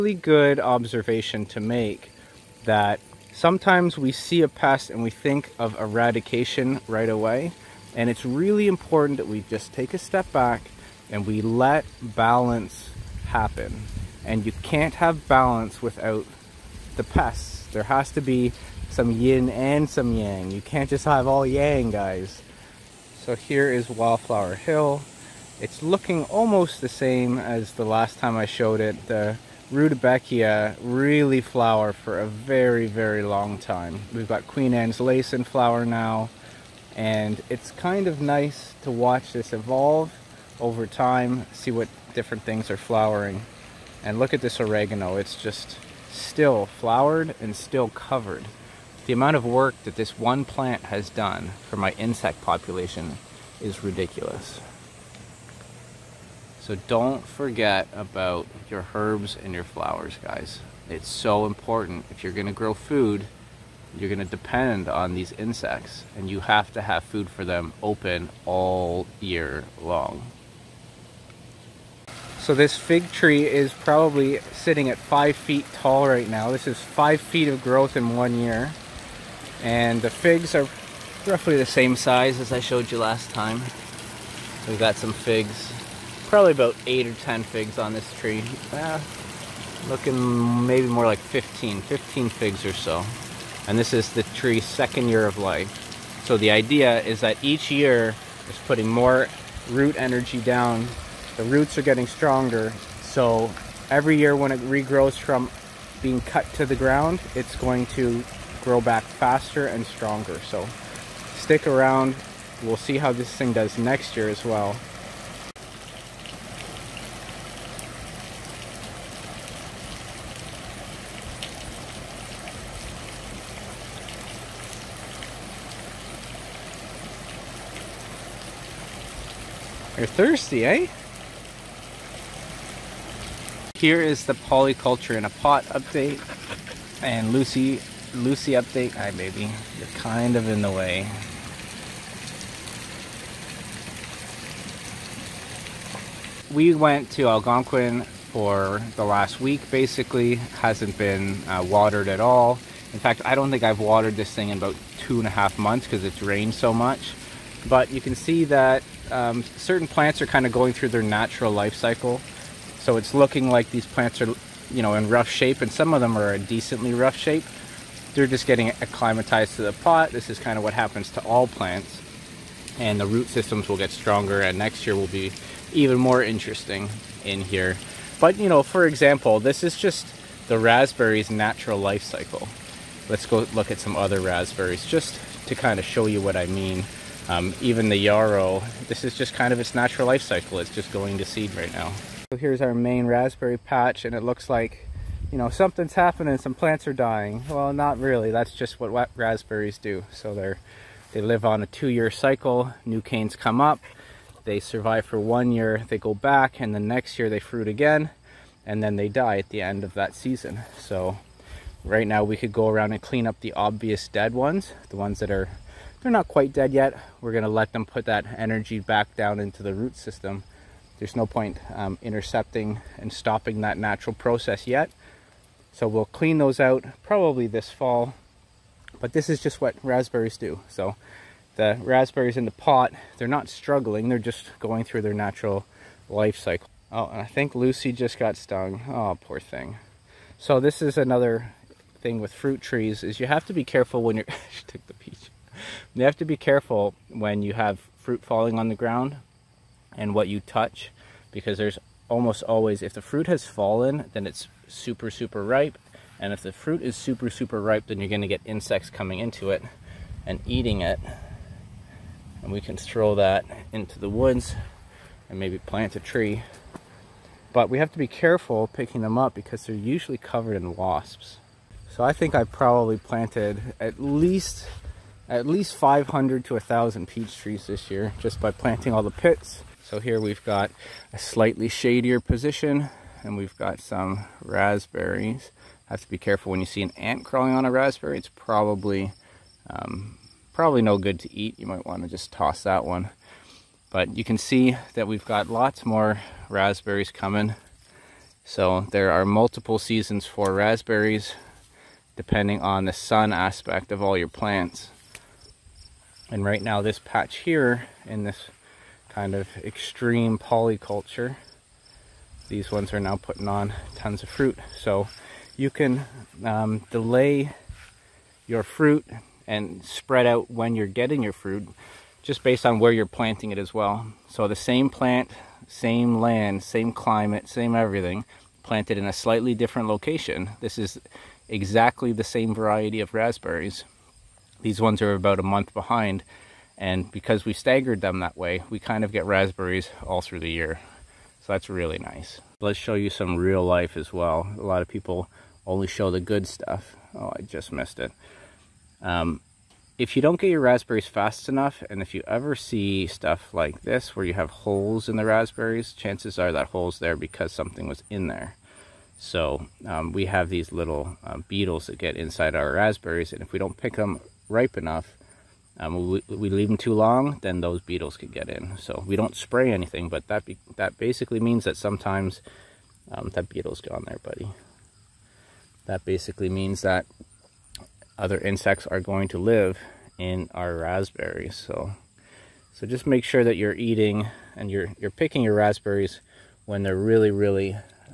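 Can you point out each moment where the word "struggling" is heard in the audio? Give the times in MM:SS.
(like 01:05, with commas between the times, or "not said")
03:53.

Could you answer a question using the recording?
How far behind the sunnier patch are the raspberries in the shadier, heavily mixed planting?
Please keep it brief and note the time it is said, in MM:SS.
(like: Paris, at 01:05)
About a month, at 05:35.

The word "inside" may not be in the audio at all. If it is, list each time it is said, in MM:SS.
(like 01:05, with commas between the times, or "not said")
06:02.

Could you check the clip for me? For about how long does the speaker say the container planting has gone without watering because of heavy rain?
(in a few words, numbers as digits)
2.5 months.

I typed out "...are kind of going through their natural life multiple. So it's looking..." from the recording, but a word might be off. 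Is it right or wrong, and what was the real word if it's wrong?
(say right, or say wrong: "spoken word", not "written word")
wrong: "cycle", not "multiple".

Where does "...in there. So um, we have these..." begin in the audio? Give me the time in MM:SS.
05:58.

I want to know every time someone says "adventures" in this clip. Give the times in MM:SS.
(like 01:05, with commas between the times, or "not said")
not said.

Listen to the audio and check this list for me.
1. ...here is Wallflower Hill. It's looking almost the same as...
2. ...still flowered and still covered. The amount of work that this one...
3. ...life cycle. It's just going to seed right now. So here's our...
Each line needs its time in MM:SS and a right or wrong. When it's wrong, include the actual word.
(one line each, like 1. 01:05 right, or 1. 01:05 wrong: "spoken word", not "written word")
1. 00:23 right
2. 00:46 right
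3. 03:10 right.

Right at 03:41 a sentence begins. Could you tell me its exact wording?
There's no point um, intercepting and stopping that natural process yet so we'll clean those out probably this fall.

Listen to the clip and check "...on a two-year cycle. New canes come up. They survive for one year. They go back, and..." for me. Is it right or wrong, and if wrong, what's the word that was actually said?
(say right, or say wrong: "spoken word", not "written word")
right.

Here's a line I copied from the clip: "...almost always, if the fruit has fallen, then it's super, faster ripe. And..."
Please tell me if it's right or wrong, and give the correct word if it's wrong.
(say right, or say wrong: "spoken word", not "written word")
wrong: "super", not "faster".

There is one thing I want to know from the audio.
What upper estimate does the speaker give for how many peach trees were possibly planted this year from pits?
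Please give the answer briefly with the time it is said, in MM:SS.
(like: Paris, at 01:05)
1,000, at 04:36.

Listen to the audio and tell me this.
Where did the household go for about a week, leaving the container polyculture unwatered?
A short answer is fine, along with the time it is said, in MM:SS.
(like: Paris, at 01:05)
Algonquin, at 02:27.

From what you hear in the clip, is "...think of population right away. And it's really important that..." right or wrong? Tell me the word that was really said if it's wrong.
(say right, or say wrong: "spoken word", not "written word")
wrong: "eradication", not "population".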